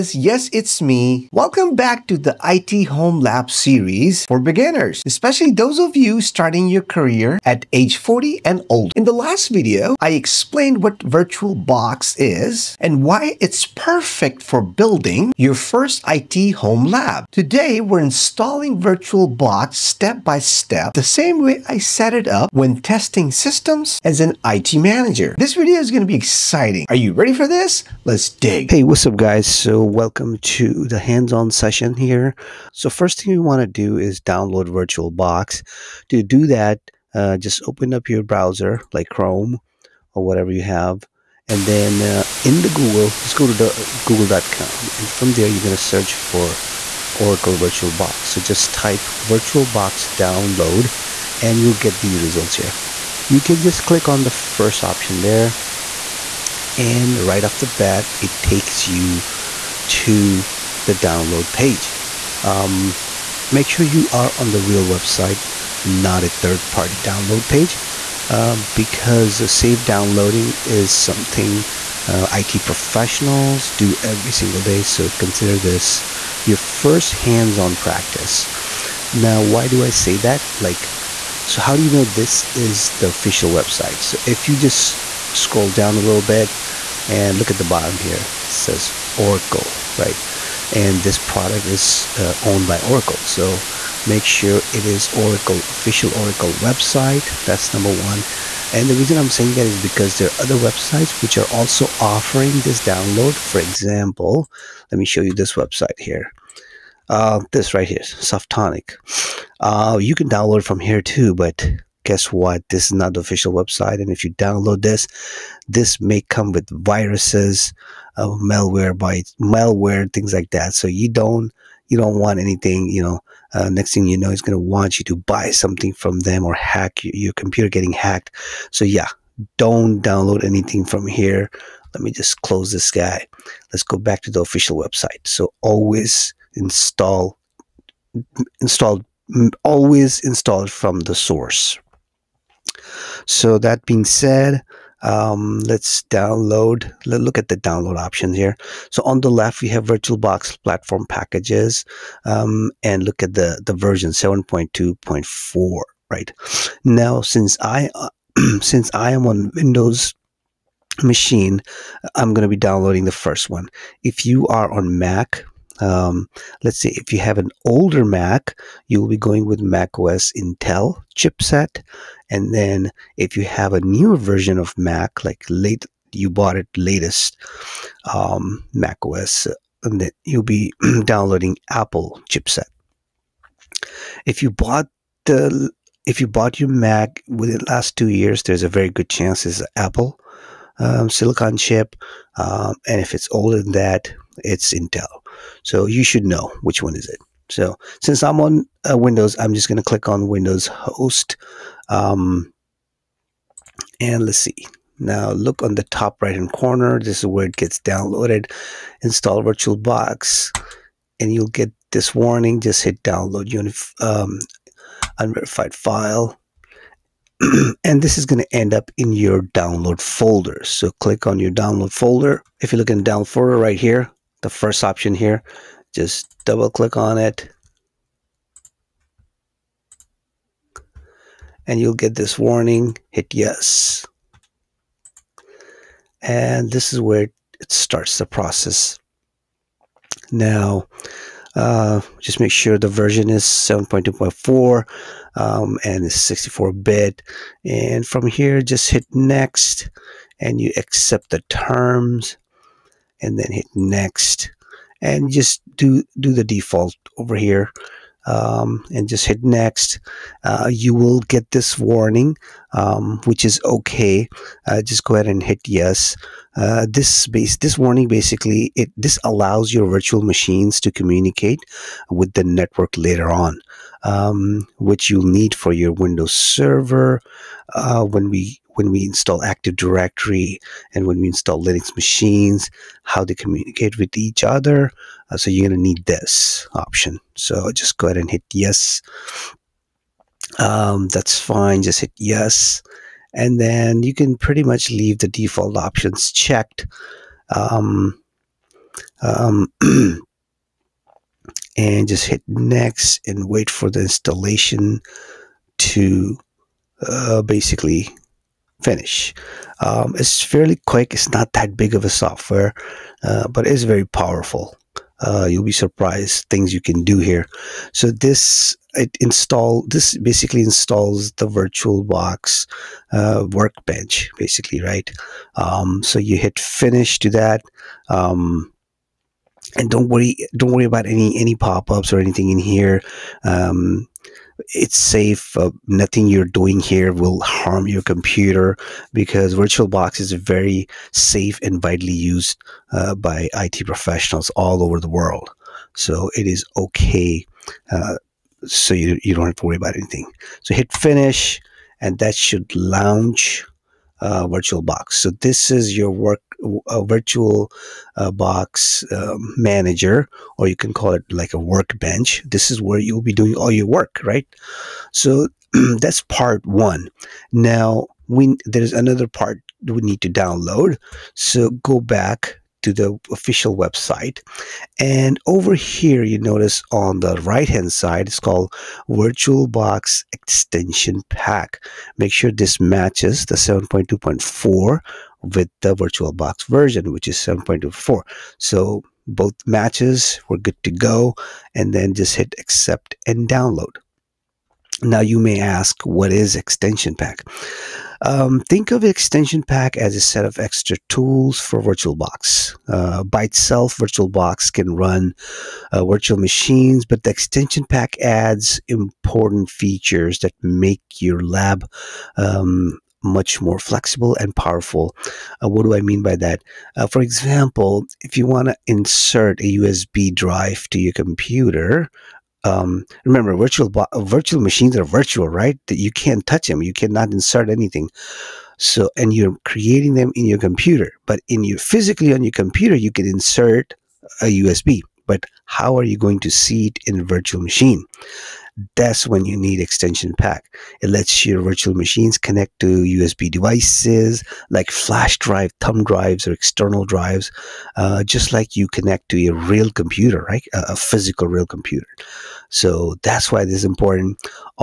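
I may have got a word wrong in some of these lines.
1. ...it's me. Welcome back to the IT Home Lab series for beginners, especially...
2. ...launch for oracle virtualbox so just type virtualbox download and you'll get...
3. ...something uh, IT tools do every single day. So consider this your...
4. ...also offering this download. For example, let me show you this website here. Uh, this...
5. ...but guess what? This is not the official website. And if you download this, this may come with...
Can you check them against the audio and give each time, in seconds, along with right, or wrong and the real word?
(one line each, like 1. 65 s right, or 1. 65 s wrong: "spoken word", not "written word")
1. 0 s right
2. 45 s wrong: "search", not "launch"
3. 70 s wrong: "professionals", not "tools"
4. 101 s right
5. 111 s right.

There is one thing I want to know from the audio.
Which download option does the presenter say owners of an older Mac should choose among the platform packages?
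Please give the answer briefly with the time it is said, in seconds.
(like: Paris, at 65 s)
Mac OS Intel chipset, at 169 s.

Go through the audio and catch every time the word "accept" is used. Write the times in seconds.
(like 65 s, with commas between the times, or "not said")
250 s, 392 s.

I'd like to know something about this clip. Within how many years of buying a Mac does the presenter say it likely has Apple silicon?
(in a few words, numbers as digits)
2 years.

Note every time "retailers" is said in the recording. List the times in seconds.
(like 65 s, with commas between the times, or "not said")
not said.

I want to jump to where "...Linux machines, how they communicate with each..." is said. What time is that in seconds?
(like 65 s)
281 s.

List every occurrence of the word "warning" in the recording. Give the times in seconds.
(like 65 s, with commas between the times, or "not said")
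212 s, 232 s, 261 s, 267 s.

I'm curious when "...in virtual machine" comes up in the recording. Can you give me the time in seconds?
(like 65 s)
437 s.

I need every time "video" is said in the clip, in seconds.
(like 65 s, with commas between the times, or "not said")
9 s, 25 s.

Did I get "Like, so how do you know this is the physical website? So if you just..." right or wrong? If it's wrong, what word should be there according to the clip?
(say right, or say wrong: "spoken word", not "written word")
wrong: "official", not "physical".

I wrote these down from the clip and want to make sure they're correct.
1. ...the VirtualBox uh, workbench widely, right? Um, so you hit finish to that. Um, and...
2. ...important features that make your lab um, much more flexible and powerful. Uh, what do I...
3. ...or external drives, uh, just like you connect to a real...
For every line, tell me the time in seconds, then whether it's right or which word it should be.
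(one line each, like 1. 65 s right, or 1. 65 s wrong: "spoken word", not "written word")
1. 321 s wrong: "basically", not "widely"
2. 408 s right
3. 446 s right.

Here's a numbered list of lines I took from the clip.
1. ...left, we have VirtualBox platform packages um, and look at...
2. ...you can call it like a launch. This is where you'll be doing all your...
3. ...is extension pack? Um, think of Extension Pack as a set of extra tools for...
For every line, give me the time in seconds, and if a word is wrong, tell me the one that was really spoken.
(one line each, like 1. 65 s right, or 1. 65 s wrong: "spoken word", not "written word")
1. 149 s right
2. 360 s wrong: "workbench", not "launch"
3. 396 s right.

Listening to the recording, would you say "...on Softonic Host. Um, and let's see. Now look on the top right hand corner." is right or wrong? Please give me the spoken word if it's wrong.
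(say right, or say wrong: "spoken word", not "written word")
wrong: "Windows", not "Softonic".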